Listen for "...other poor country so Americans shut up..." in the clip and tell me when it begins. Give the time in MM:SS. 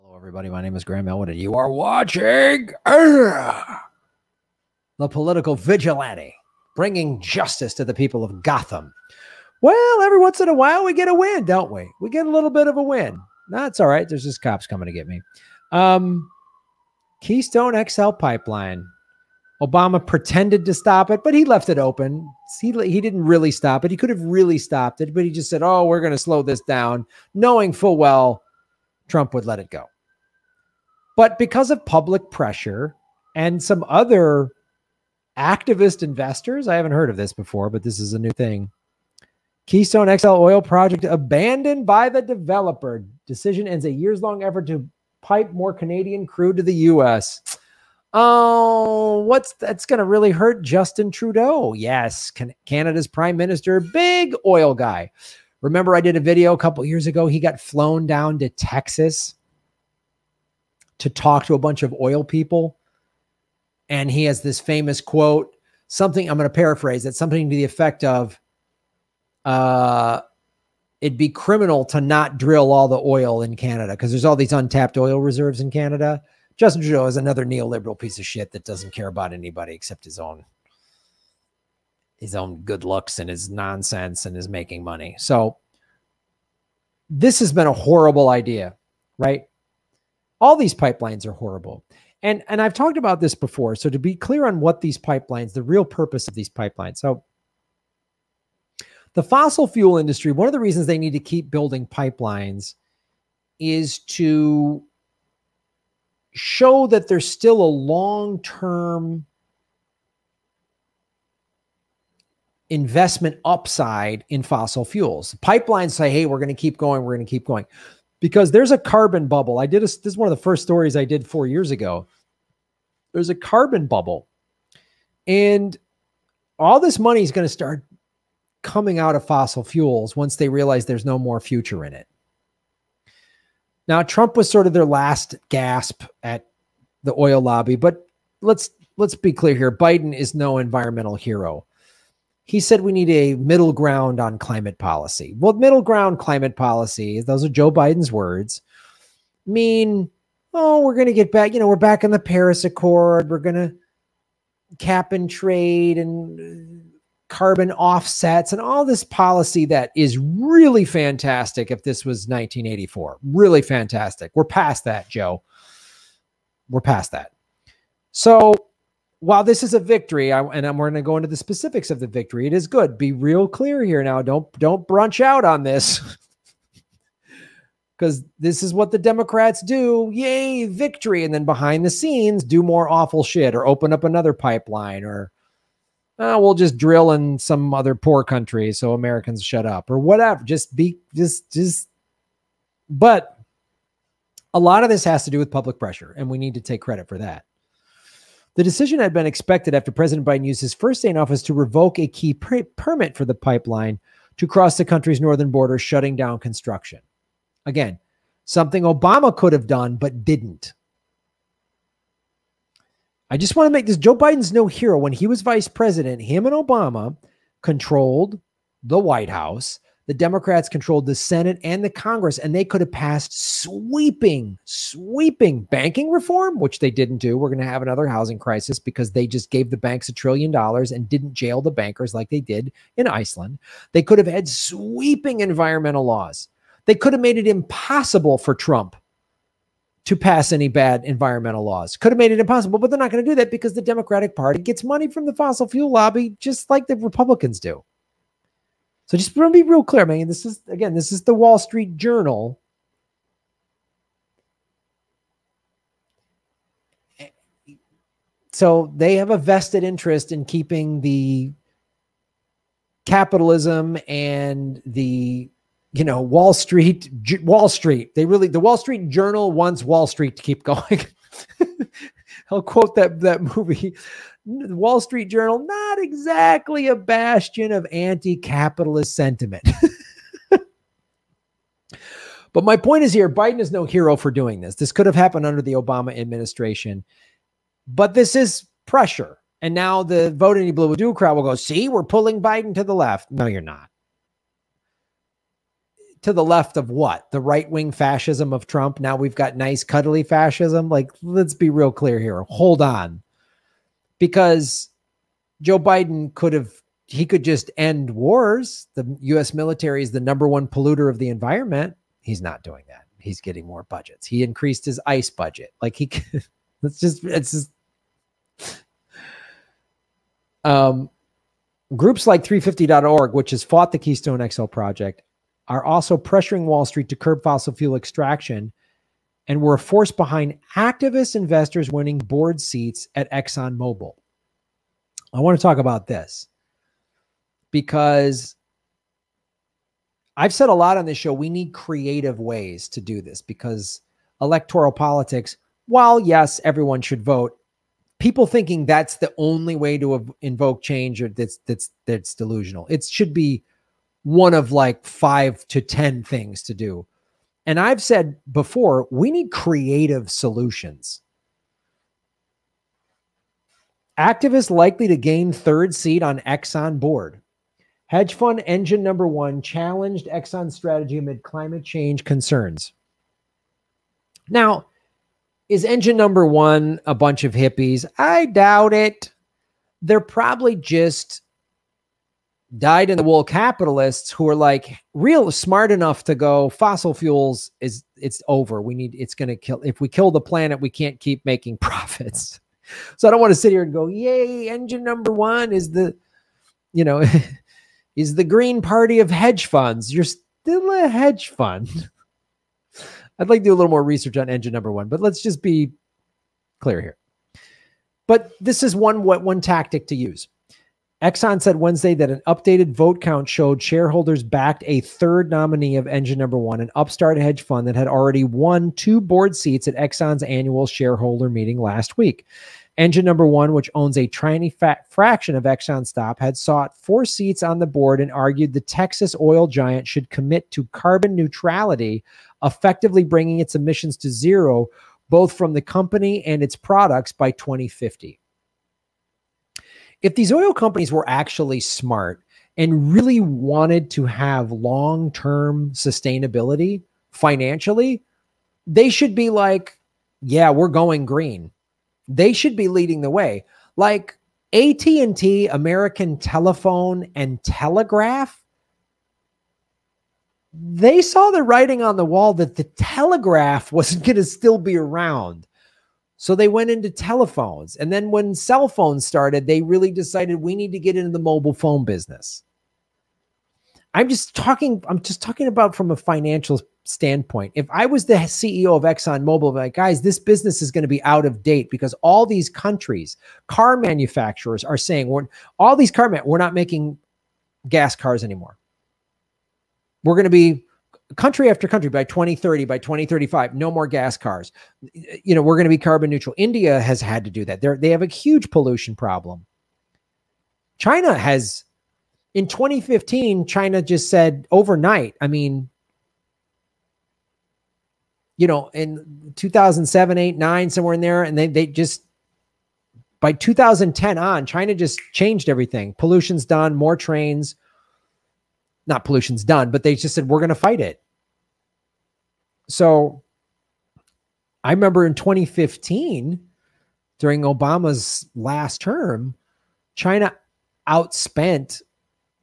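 03:07.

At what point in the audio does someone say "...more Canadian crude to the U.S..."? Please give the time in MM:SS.
00:45.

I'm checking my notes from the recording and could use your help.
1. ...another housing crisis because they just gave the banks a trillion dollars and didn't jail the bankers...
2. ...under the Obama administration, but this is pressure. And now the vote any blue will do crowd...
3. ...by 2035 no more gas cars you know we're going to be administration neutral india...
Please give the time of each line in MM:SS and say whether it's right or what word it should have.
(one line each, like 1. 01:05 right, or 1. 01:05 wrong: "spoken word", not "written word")
1. 03:47 right
2. 04:45 right
3. 08:12 wrong: "carbon", not "administration".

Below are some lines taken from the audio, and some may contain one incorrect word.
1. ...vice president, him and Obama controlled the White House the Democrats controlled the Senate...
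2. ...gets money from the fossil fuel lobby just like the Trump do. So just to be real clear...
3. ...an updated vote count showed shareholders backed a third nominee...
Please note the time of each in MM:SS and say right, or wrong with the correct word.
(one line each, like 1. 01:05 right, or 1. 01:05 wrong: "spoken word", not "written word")
1. 03:35 right
2. 04:04 wrong: "Republicans", not "Trump"
3. 06:52 right.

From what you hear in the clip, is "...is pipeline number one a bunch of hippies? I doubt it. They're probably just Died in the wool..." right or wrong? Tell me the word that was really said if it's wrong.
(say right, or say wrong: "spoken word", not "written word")
wrong: "engine", not "pipeline".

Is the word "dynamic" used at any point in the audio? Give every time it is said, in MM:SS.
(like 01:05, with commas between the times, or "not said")
not said.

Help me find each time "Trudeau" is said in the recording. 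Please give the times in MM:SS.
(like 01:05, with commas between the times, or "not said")
00:51, 01:16.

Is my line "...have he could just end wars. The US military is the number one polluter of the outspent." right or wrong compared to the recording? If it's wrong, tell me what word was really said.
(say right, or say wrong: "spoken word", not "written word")
wrong: "environment", not "outspent".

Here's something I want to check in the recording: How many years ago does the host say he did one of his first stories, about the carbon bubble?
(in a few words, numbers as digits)
4.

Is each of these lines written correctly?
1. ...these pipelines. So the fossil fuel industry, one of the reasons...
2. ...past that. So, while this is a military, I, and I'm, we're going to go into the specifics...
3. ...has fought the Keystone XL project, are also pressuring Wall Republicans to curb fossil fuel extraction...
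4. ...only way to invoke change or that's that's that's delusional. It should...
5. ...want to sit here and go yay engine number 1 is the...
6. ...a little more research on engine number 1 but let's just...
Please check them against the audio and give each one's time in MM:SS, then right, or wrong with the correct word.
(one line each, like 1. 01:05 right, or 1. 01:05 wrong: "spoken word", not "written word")
1. 01:36 right
2. 02:46 wrong: "victory", not "military"
3. 05:23 wrong: "Street", not "Republicans"
4. 05:49 right
5. 06:33 right
6. 06:43 right.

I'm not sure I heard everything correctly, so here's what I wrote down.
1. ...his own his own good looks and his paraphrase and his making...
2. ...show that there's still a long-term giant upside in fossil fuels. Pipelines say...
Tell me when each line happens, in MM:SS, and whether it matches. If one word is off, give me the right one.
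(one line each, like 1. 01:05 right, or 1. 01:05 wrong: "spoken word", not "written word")
1. 01:20 wrong: "nonsense", not "paraphrase"
2. 01:46 wrong: "investment", not "giant".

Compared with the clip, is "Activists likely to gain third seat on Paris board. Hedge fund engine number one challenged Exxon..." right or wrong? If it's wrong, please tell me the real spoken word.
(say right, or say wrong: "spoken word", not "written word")
wrong: "Exxon", not "Paris".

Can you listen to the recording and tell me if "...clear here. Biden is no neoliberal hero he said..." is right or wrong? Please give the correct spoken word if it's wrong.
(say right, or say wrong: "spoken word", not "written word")
wrong: "environmental", not "neoliberal".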